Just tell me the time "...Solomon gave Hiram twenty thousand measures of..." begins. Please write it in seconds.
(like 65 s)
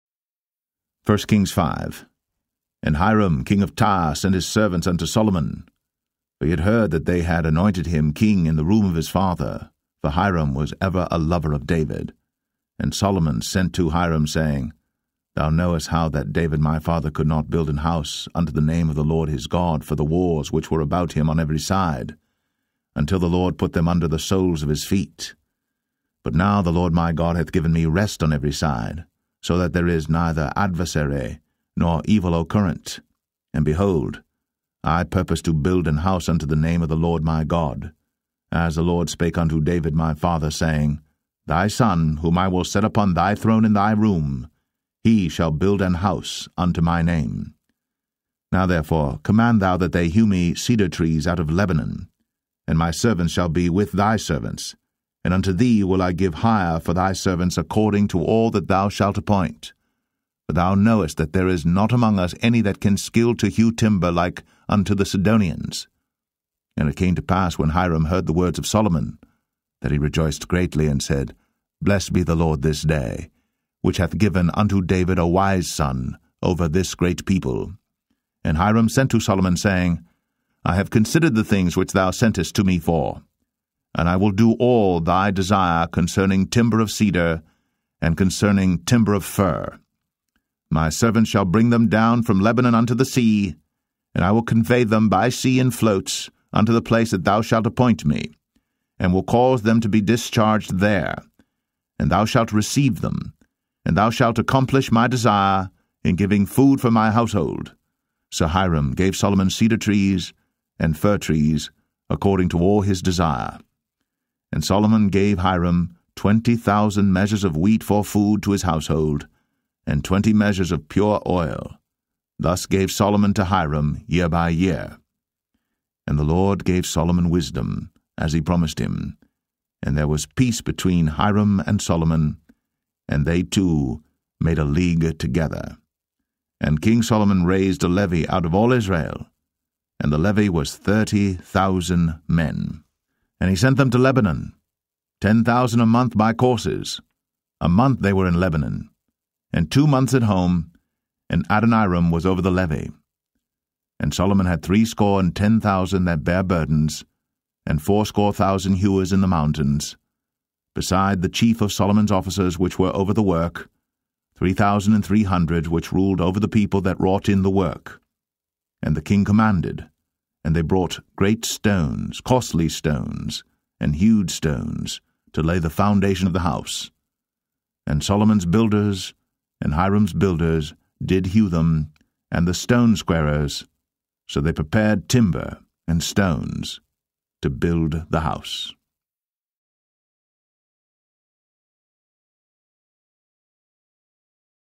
114 s.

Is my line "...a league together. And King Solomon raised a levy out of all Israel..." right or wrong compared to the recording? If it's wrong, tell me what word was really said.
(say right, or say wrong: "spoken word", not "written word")
right.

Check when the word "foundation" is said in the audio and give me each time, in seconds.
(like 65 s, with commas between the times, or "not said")
175 s.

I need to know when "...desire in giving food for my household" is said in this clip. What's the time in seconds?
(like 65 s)
105 s.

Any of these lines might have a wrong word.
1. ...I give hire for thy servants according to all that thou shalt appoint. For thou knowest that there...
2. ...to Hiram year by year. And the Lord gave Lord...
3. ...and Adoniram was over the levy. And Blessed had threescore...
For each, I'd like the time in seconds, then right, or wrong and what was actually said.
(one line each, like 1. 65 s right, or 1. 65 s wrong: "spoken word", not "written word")
1. 56 s right
2. 123 s wrong: "Solomon", not "Lord"
3. 151 s wrong: "Solomon", not "Blessed".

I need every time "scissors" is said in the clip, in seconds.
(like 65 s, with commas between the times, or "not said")
not said.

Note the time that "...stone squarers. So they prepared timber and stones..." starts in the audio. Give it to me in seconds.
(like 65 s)
182 s.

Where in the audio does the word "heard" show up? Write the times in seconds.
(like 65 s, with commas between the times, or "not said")
6 s, 68 s.